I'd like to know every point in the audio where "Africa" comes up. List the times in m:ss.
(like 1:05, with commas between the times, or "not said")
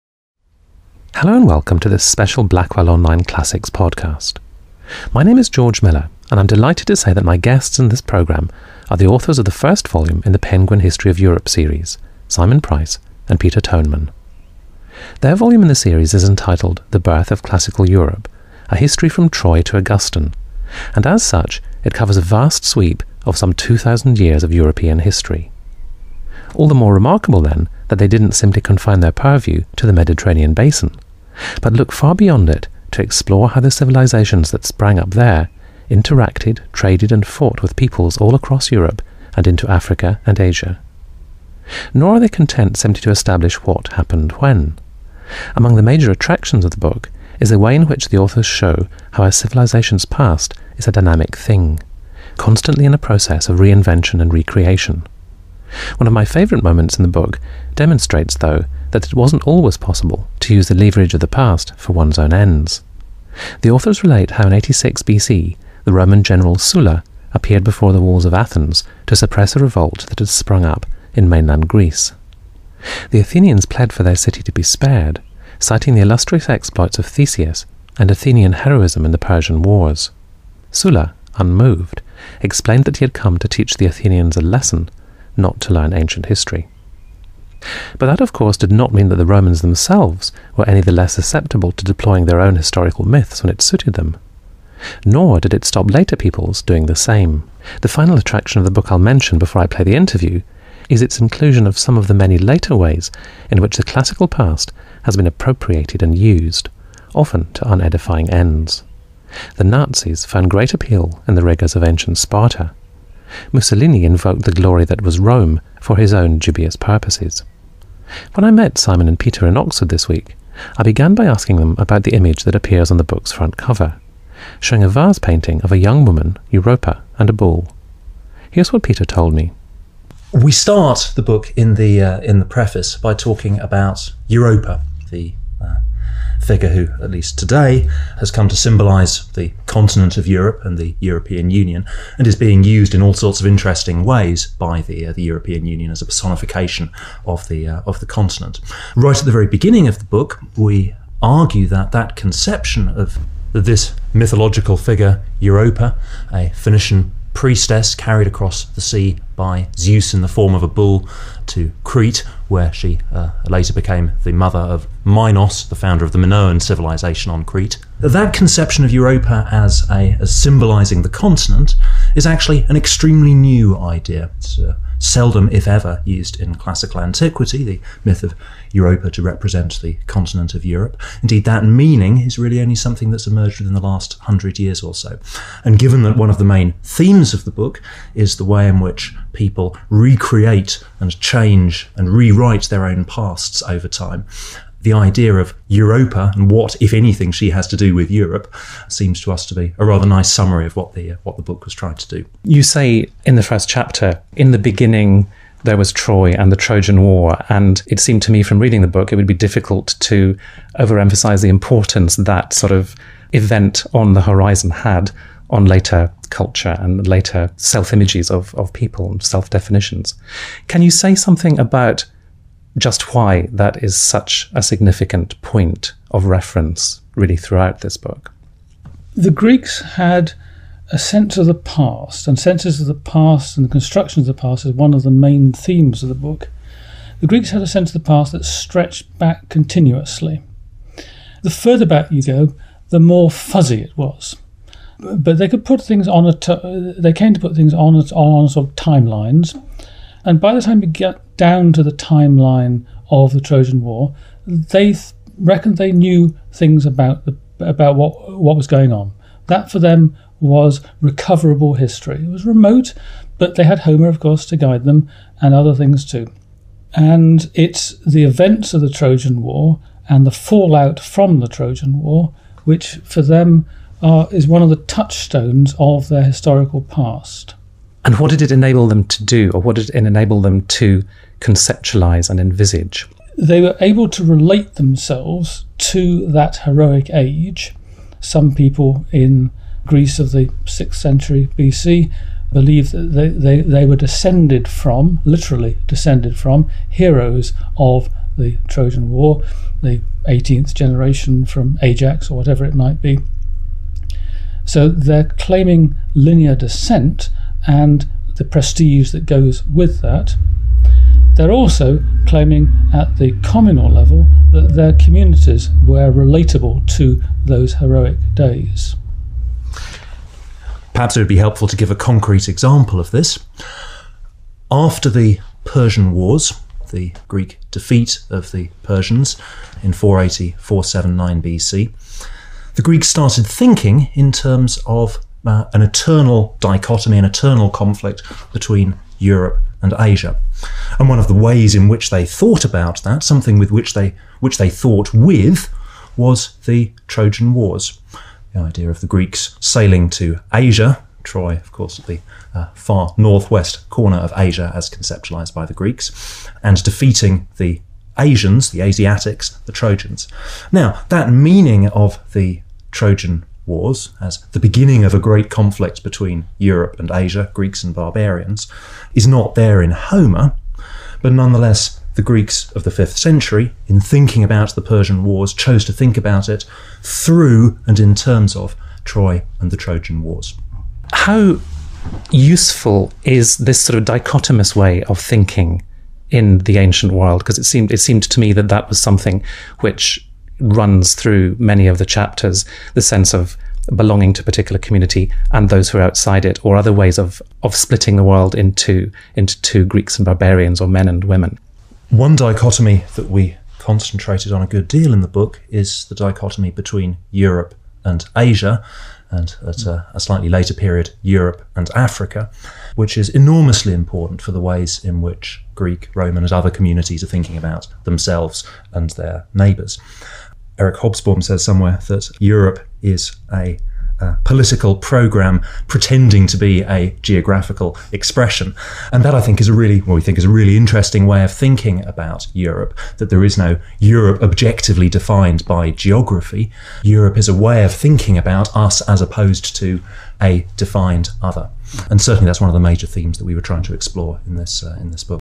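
0:39, 6:51.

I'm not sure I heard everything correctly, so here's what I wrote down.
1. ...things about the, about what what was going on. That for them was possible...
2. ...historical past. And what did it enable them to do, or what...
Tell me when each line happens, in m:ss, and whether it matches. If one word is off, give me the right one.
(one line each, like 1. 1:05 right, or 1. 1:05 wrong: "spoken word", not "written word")
1. 4:16 wrong: "recoverable", not "possible"
2. 4:36 right.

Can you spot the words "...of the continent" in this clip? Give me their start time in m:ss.
2:27.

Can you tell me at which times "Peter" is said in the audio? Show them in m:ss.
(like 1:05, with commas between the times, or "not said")
0:13, 1:59, 2:08.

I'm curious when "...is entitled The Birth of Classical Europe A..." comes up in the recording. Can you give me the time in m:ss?
0:16.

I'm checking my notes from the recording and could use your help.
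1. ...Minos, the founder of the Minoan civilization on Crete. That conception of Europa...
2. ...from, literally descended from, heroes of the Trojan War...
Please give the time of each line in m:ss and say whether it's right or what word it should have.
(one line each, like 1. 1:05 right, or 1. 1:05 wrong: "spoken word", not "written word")
1. 2:45 right
2. 4:54 right.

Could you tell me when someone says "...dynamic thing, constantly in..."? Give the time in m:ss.
0:50.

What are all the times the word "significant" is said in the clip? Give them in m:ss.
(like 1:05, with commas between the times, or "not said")
3:44.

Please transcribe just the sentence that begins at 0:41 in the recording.
Nor are they content simply to establish what happened when.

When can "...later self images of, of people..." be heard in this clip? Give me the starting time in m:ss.
3:37.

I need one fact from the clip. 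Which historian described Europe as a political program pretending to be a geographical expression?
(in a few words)
Eric Hobsbawm.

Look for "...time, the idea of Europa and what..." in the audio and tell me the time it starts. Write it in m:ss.
3:13.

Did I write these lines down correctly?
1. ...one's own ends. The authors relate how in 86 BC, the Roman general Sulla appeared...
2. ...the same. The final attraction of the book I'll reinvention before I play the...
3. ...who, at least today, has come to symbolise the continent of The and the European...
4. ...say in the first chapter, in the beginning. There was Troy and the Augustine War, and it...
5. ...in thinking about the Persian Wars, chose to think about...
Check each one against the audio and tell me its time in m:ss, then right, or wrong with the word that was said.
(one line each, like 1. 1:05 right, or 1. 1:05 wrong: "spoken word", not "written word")
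1. 1:01 right
2. 1:36 wrong: "mention", not "reinvention"
3. 2:16 wrong: "Europe", not "The"
4. 3:22 wrong: "Trojan", not "Augustine"
5. 6:13 right.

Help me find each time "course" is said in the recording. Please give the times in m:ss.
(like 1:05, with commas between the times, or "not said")
1:28, 4:24, 5:51.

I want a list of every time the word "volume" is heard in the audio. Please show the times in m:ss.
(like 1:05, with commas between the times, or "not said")
0:09, 0:15.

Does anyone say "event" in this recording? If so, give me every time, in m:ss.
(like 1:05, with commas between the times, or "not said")
3:33, 4:28.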